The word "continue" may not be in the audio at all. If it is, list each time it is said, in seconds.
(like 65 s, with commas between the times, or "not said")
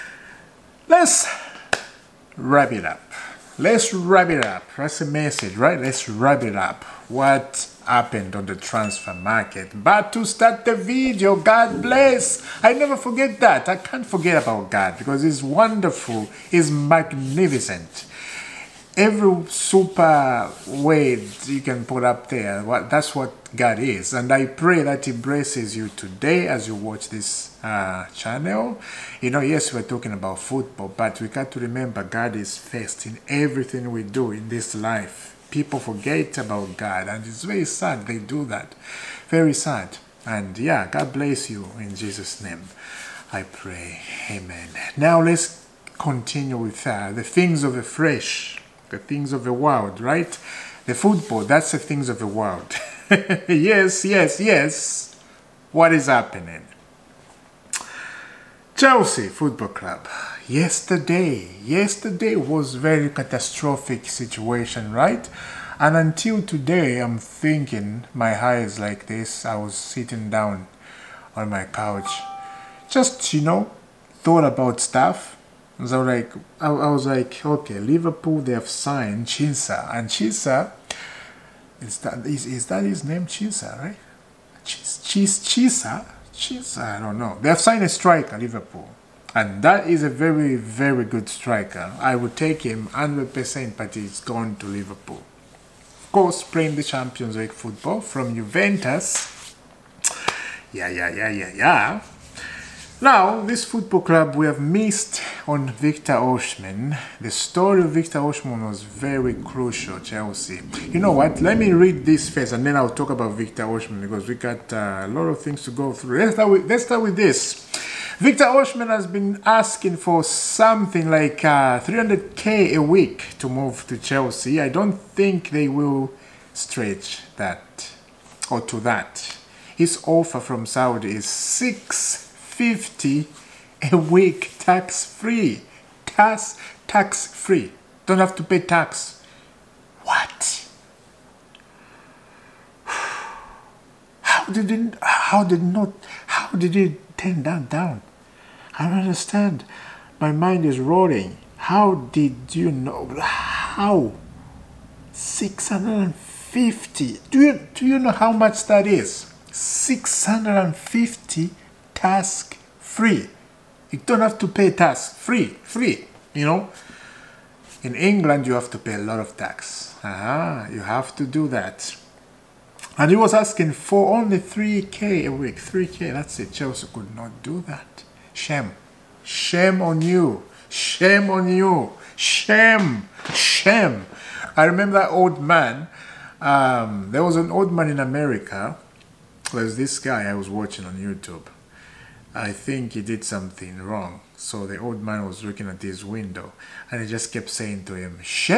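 45 s.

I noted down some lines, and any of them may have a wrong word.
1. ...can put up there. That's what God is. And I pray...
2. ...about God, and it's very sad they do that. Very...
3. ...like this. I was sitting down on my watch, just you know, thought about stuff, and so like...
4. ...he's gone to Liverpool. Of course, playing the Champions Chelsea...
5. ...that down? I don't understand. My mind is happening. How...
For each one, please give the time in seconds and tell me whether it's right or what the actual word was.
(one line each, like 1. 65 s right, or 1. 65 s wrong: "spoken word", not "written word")
1. 21 s right
2. 36 s right
3. 68 s wrong: "couch", not "watch"
4. 93 s wrong: "League", not "Chelsea"
5. 147 s wrong: "rolling", not "happening".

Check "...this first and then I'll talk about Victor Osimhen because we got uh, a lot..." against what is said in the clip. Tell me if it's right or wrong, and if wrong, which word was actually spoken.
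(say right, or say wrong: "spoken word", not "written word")
right.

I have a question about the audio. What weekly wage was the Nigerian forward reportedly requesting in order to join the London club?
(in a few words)
300k a week.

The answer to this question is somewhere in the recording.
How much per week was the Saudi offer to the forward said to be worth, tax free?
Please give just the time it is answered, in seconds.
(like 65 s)
131 s.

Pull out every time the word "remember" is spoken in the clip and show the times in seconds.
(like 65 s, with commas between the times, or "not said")
31 s, 184 s.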